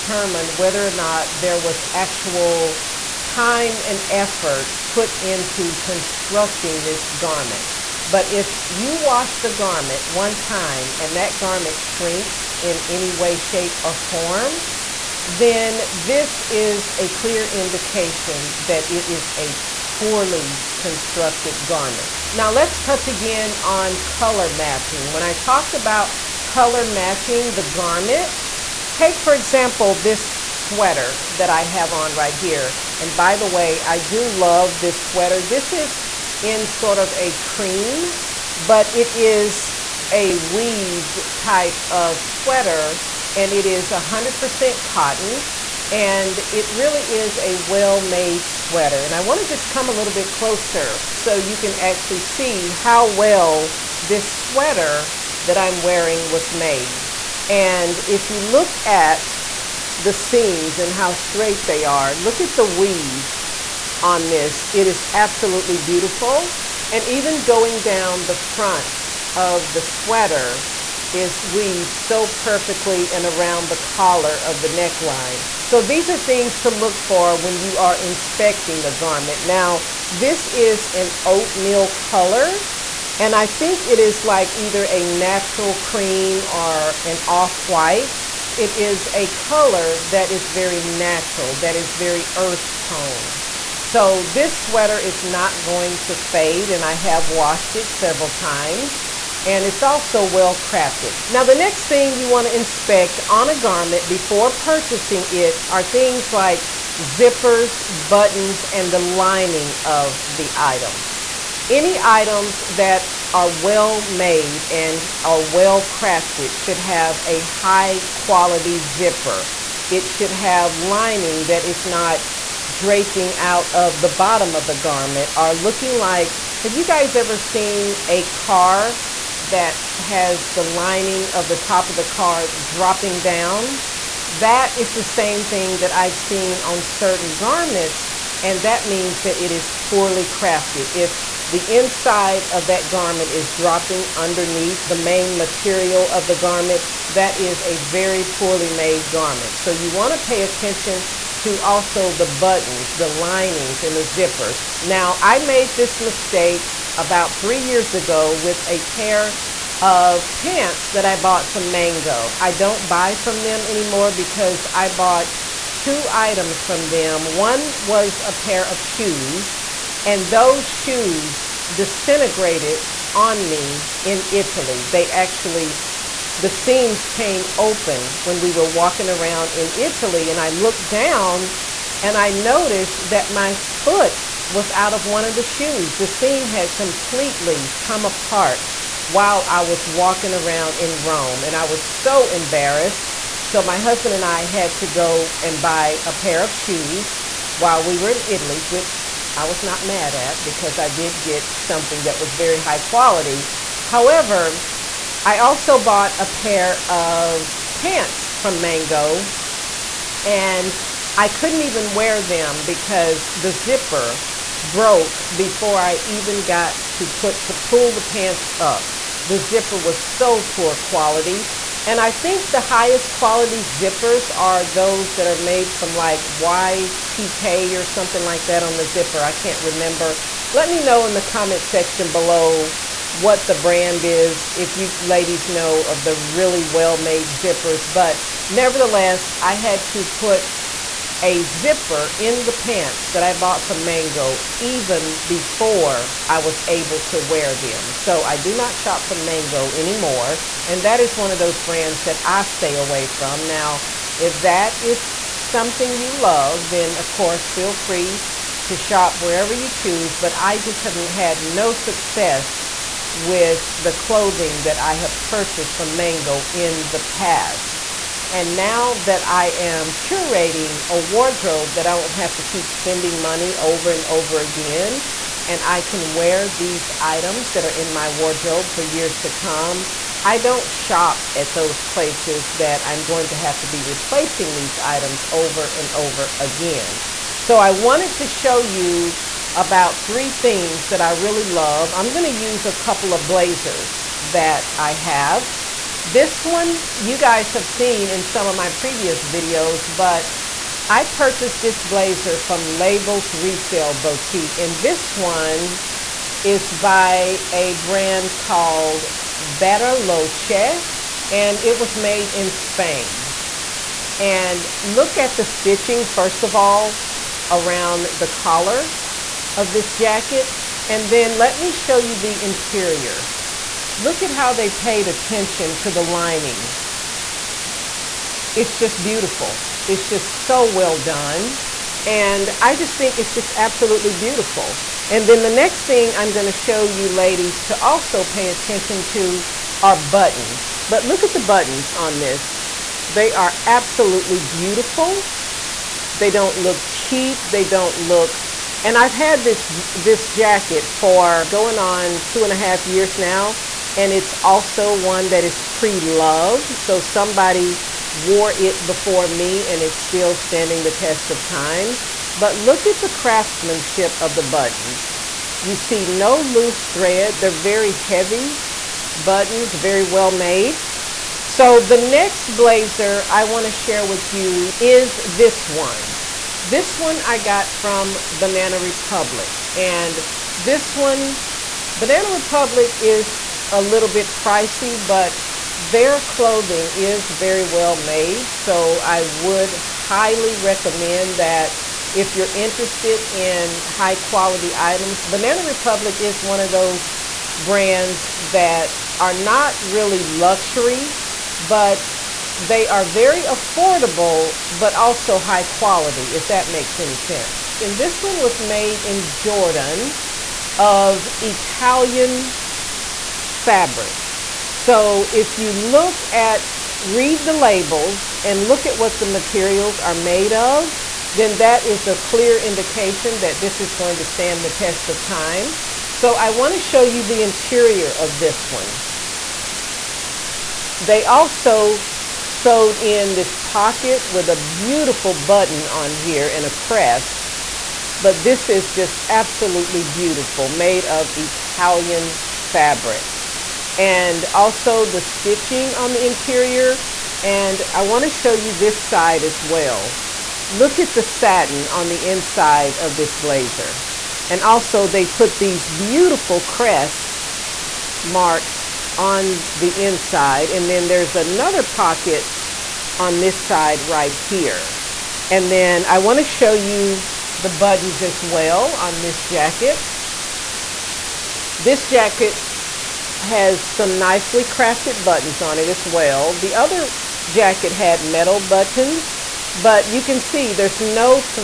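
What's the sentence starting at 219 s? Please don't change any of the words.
The zipper was so poor quality.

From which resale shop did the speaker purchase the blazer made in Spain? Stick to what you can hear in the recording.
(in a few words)
Labels Resale Boutique.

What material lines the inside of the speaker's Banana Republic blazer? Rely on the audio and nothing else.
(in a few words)
satin.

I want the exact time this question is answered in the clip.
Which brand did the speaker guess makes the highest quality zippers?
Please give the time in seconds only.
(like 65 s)
226 s.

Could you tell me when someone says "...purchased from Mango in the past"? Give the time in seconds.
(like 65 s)
265 s.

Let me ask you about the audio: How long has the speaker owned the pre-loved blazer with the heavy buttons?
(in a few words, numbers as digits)
2 and a half years.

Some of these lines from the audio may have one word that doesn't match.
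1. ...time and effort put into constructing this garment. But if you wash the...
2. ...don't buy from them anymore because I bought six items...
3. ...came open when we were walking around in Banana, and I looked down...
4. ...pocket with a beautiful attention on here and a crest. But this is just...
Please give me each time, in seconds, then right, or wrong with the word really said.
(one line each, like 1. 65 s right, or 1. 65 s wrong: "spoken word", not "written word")
1. 3 s right
2. 162 s wrong: "two", not "six"
3. 177 s wrong: "Italy", not "Banana"
4. 433 s wrong: "button", not "attention".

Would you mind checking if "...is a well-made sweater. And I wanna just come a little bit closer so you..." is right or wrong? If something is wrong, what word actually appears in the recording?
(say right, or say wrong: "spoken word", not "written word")
right.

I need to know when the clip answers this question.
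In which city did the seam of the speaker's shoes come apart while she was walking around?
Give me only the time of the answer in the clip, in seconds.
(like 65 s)
191 s.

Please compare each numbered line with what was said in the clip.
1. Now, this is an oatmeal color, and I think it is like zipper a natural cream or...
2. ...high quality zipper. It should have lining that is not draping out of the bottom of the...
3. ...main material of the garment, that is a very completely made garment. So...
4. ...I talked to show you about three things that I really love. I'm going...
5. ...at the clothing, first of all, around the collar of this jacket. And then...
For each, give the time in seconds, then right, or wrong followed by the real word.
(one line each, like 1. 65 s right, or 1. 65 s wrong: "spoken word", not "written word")
1. 79 s wrong: "either", not "zipper"
2. 117 s right
3. 144 s wrong: "poorly", not "completely"
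4. 287 s wrong: "wanted", not "talked"
5. 315 s wrong: "stitching", not "clothing".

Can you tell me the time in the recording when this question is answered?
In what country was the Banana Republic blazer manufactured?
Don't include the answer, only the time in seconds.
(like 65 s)
409 s.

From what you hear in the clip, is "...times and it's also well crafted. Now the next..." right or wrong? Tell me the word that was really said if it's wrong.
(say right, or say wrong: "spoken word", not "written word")
right.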